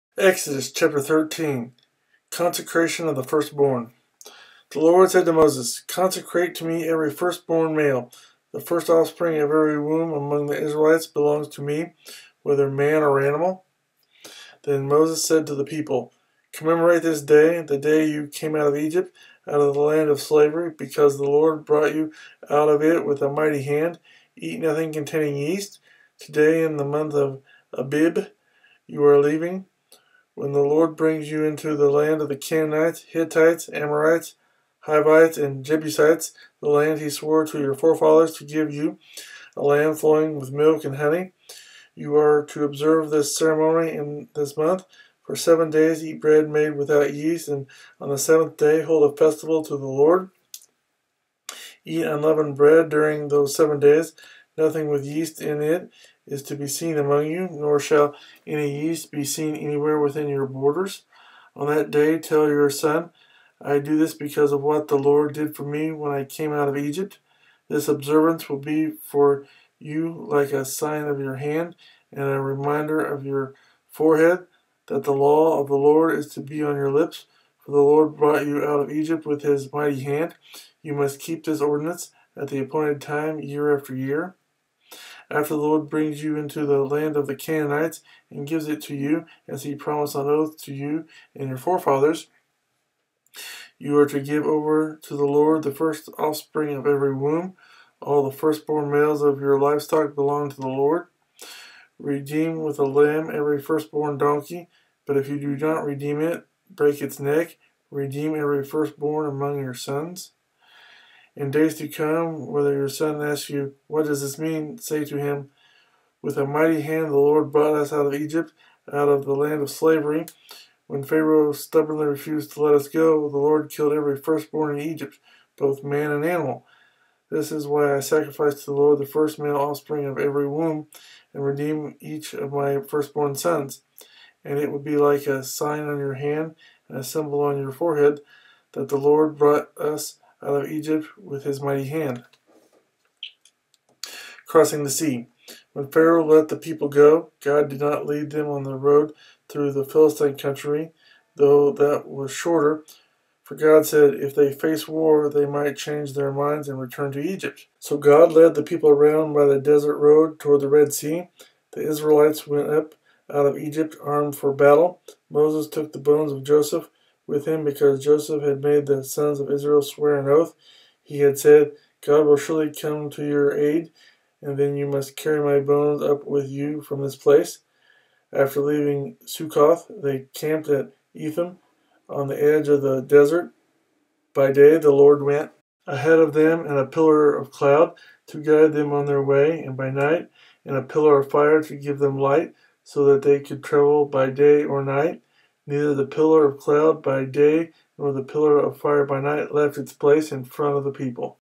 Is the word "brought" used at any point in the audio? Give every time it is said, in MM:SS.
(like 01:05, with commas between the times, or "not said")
00:21, 01:18, 01:57, 02:19.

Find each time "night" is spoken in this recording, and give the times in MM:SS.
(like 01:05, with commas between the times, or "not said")
03:09, 03:14, 03:19.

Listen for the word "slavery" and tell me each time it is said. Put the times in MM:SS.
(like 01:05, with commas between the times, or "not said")
00:20, 01:59.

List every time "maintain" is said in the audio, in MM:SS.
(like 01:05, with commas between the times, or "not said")
not said.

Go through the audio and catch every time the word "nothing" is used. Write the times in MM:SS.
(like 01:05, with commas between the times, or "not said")
00:24, 00:54.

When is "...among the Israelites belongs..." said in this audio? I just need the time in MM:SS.
00:10.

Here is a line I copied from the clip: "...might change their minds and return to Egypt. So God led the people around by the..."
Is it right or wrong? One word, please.
right.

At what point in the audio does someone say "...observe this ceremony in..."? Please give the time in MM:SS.
00:42.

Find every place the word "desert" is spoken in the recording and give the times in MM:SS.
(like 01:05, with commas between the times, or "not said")
02:39, 03:03.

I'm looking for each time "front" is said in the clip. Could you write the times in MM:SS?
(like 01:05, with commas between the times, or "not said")
03:20.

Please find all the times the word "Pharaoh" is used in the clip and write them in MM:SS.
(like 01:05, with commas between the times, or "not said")
02:01, 02:25.